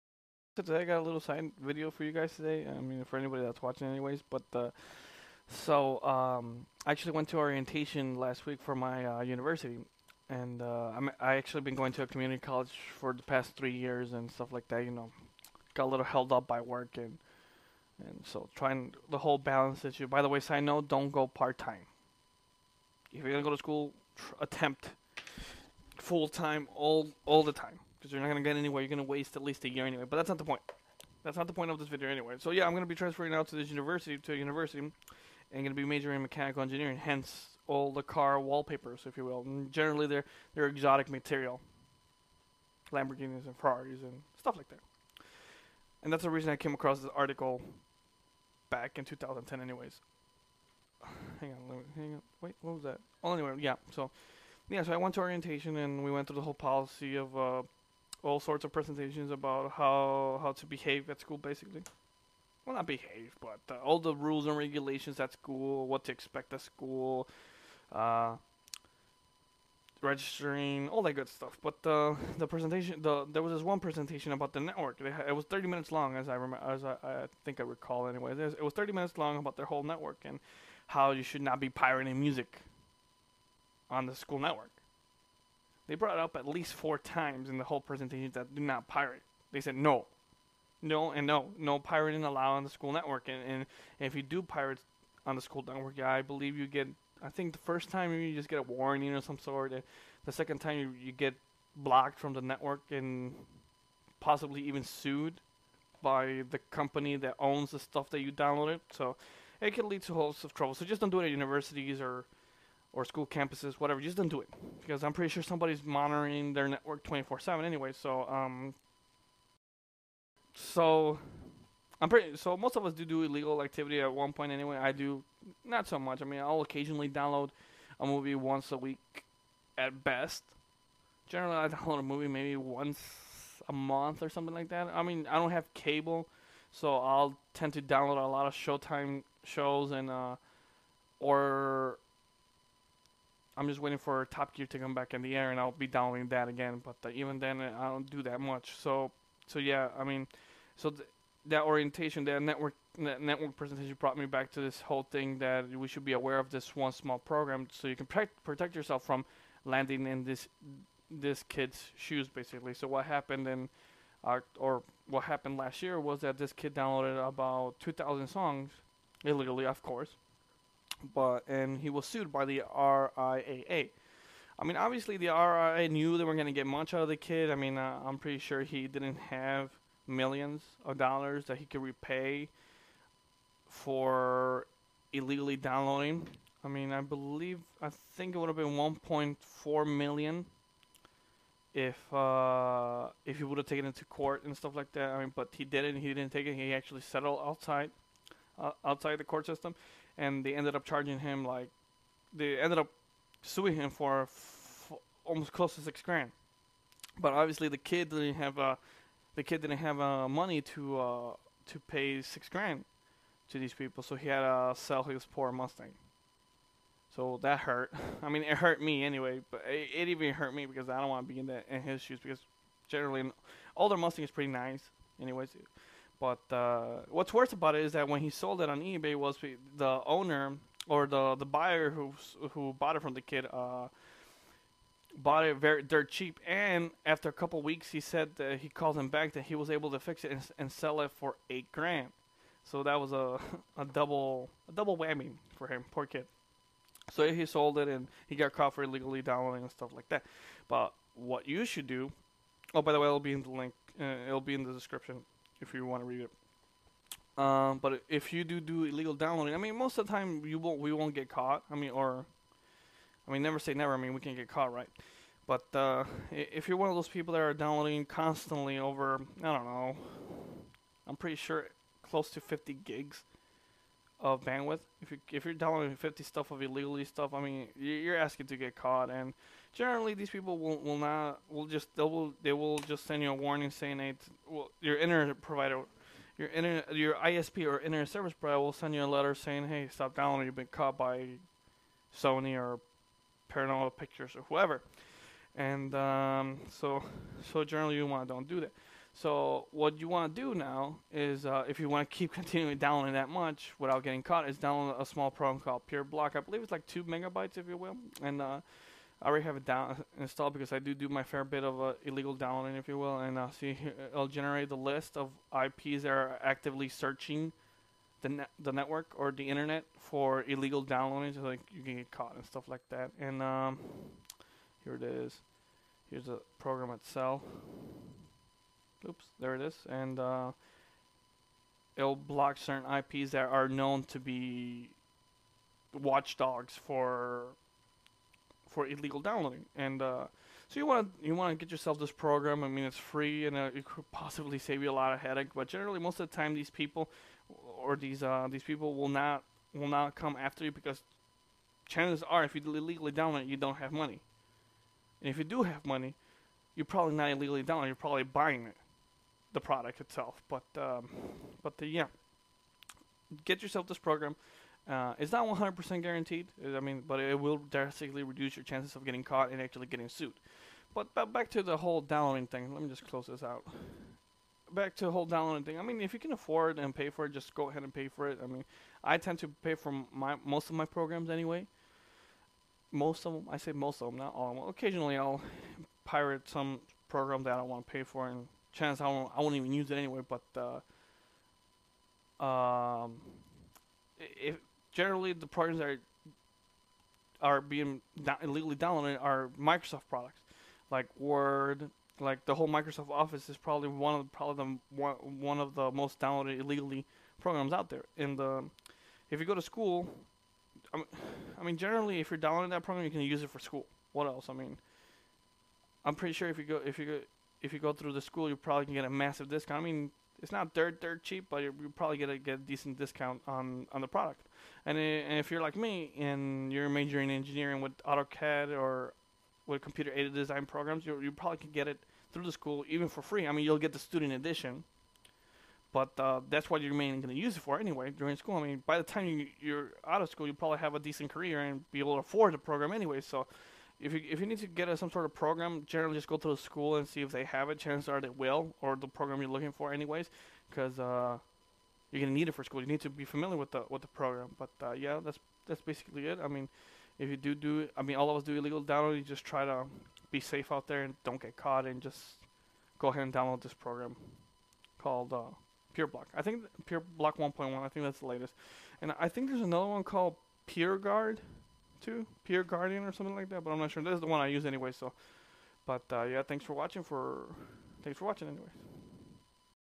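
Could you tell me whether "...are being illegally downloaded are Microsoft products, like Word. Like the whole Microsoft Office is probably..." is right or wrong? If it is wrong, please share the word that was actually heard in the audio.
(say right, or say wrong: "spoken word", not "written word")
right.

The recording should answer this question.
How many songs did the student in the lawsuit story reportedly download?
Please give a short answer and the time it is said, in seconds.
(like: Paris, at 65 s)
2,000, at 167 s.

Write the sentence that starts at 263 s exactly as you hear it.
I mean, we can get caught, right?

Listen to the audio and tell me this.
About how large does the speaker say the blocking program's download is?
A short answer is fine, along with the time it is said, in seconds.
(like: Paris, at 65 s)
2 megabytes, at 306 s.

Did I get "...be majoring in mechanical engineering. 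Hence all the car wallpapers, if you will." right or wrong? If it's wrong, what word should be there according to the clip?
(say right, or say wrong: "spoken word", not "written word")
right.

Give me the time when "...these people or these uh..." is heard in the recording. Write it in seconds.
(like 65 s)
346 s.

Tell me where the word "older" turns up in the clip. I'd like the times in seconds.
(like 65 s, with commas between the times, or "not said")
223 s.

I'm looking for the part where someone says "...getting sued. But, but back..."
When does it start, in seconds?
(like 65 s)
369 s.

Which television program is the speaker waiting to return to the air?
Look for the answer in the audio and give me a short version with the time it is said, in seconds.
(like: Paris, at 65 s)
Top Gear, at 144 s.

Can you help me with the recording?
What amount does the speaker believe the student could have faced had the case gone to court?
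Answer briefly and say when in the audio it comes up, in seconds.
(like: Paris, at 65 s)
1.4 million, at 188 s.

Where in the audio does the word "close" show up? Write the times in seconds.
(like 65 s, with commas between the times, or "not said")
205 s, 272 s, 373 s.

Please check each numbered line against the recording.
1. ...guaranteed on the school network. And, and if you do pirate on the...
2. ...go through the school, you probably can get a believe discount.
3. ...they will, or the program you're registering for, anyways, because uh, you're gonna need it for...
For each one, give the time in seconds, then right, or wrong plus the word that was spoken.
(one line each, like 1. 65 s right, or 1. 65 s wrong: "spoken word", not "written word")
1. 92 s wrong: "allowed", not "guaranteed"
2. 417 s wrong: "massive", not "believe"
3. 448 s wrong: "looking", not "registering".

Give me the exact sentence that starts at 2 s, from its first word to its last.
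I mean, for anybody that's watching, anyways.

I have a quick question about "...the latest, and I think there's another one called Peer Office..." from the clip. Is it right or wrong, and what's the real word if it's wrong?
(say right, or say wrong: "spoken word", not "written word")
wrong: "Guard", not "Office".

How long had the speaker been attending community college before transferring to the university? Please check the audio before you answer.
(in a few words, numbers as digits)
3 years.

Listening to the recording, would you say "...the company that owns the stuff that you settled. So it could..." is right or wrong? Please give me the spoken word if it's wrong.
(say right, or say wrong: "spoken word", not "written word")
wrong: "downloaded", not "settled".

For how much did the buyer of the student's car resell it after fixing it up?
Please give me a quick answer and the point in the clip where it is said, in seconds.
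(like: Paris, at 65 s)
8 grand, at 241 s.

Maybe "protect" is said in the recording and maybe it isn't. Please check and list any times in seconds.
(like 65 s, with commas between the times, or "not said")
158 s.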